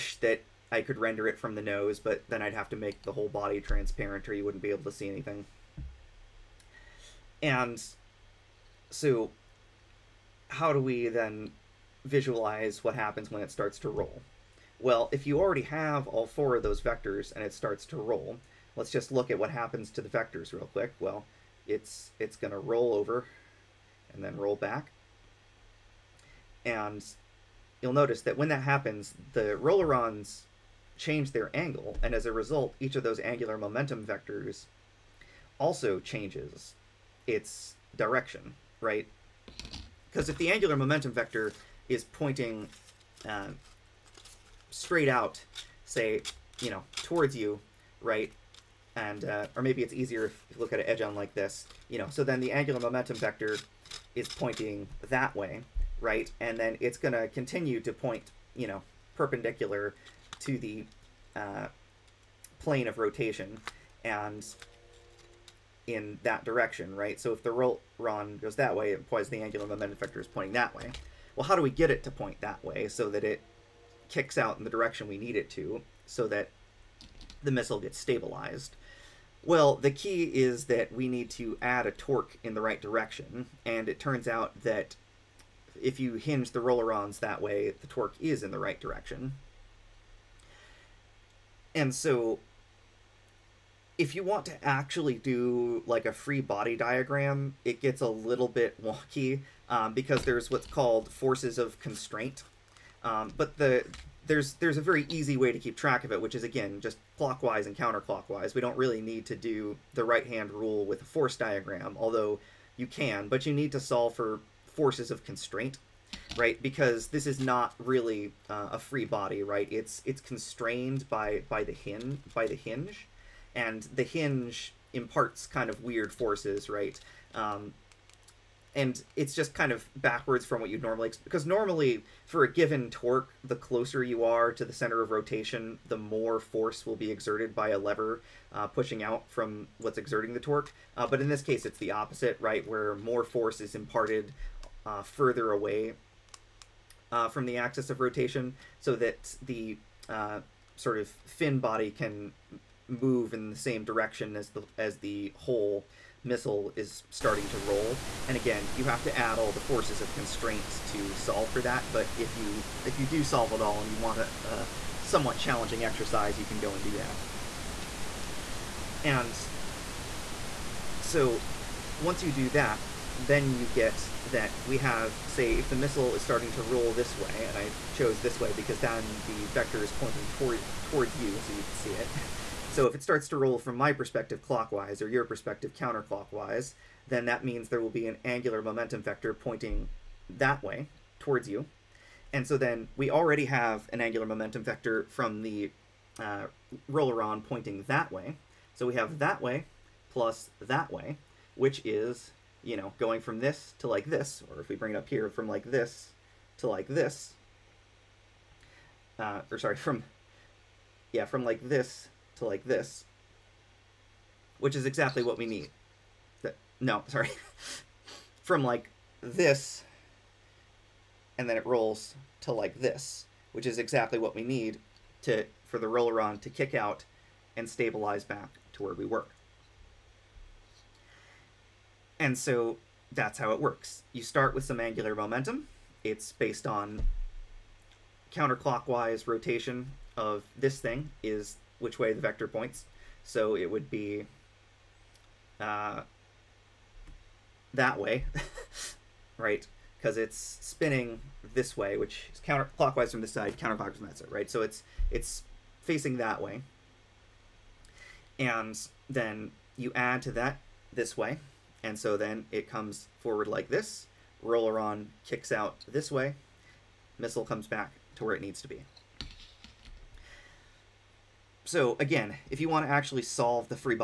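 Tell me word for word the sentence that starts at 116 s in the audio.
Because this is not really uh, a free body, right?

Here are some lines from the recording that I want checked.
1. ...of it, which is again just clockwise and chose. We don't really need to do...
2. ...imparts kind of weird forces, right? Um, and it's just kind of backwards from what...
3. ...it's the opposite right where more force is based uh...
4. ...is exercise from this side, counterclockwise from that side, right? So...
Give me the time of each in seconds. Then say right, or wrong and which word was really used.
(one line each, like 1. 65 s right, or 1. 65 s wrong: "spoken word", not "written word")
1. 106 s wrong: "counterclockwise", not "chose"
2. 124 s right
3. 141 s wrong: "imparted", not "based"
4. 252 s wrong: "counterclockwise", not "exercise".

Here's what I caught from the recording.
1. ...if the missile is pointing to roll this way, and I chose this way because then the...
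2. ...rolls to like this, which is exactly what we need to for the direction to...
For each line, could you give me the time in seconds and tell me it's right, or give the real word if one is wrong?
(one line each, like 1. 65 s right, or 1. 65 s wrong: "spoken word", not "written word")
1. 175 s wrong: "starting", not "pointing"
2. 221 s wrong: "rolleron", not "direction".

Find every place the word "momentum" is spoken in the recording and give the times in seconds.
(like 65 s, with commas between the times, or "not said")
33 s, 40 s, 52 s, 69 s, 188 s, 194 s, 235 s.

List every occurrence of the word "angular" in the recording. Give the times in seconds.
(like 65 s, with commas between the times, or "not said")
33 s, 40 s, 52 s, 69 s, 188 s, 193 s, 234 s.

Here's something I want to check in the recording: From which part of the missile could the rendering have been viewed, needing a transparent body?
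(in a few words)
the nose.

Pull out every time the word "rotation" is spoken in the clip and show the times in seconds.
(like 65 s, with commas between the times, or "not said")
62 s, 135 s, 148 s, 239 s.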